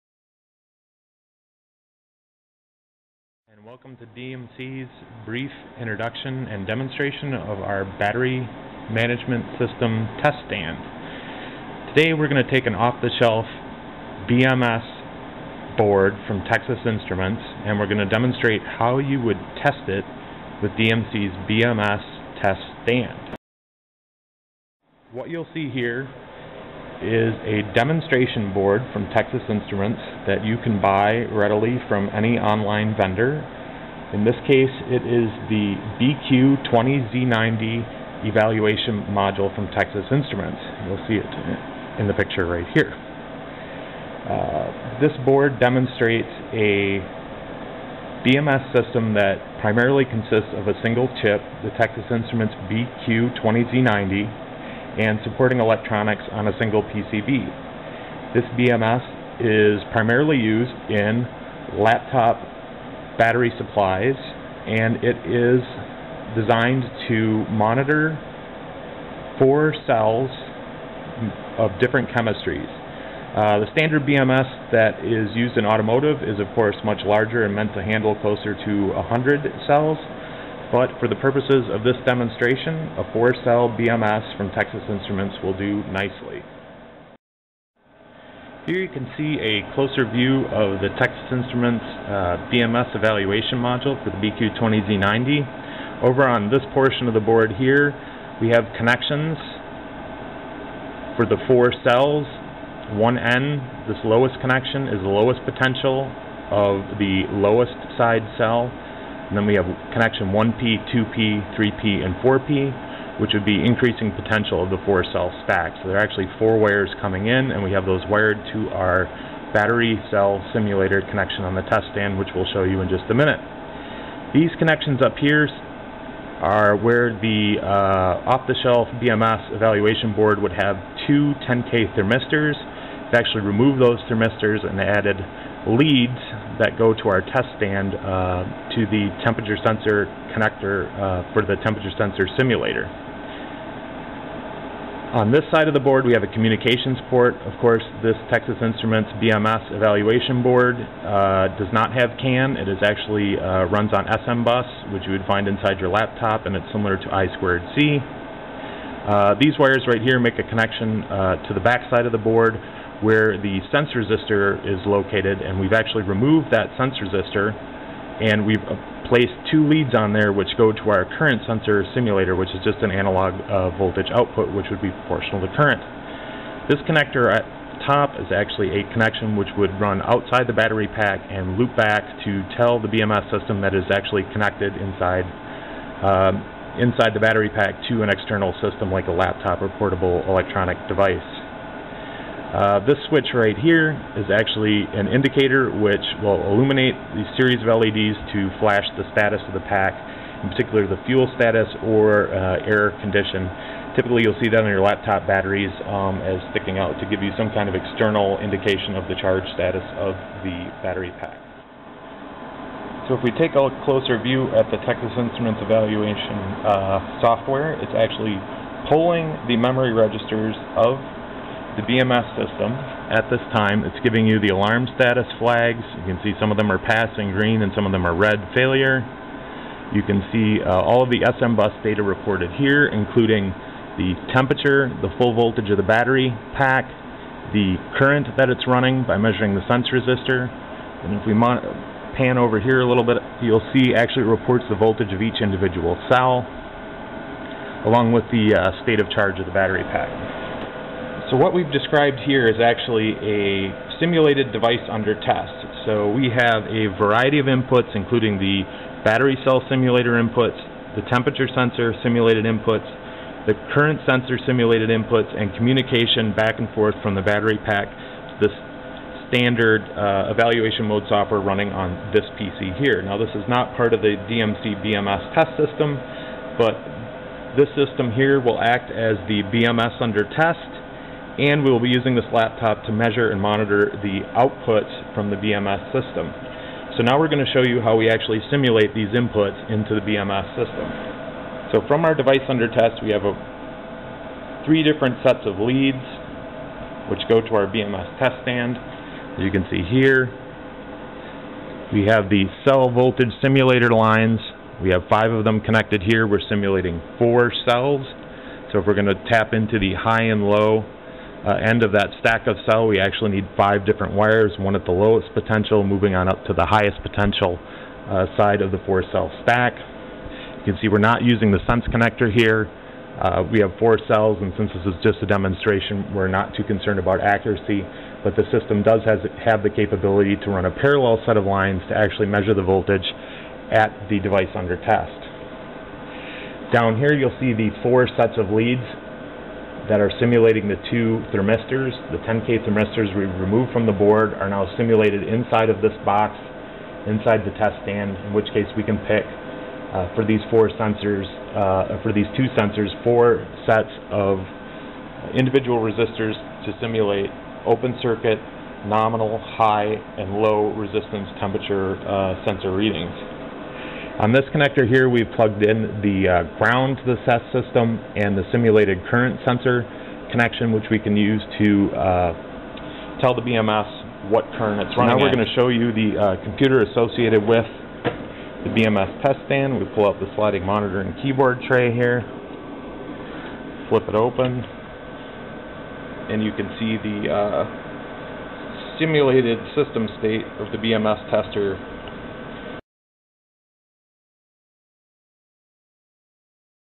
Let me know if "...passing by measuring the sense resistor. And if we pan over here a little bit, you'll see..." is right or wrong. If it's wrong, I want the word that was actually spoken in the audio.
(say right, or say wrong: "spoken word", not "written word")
wrong: "running", not "passing".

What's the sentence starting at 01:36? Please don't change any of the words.
Over on this portion of the board here, we have connections for the four cells.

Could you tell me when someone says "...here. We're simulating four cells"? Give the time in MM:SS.
05:06.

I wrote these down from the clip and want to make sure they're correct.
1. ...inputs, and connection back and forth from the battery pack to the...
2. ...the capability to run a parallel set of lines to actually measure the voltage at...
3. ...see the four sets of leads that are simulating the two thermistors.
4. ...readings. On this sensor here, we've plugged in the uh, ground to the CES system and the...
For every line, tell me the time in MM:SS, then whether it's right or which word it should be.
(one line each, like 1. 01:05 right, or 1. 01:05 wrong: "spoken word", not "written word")
1. 04:24 wrong: "communication", not "connection"
2. 05:29 right
3. 05:37 right
4. 06:02 wrong: "connector", not "sensor".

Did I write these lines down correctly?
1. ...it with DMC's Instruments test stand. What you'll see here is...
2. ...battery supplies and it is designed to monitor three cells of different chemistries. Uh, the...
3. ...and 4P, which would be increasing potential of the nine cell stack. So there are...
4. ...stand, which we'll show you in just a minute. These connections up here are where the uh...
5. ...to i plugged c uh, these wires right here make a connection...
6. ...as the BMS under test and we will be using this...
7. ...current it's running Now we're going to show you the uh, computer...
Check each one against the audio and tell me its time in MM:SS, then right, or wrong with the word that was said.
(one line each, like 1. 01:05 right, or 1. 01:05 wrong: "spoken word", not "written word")
1. 00:19 wrong: "BMS", not "Instruments"
2. 01:03 wrong: "four", not "three"
3. 01:52 wrong: "four", not "nine"
4. 02:01 right
5. 02:36 wrong: "squared", not "plugged"
6. 04:38 right
7. 06:14 right.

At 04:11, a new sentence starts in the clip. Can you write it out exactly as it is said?
So what we've described here is actually a simulated device under test.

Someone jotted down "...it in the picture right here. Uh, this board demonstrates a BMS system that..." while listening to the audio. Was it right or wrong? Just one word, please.
right.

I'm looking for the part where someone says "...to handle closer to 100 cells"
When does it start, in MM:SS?
01:17.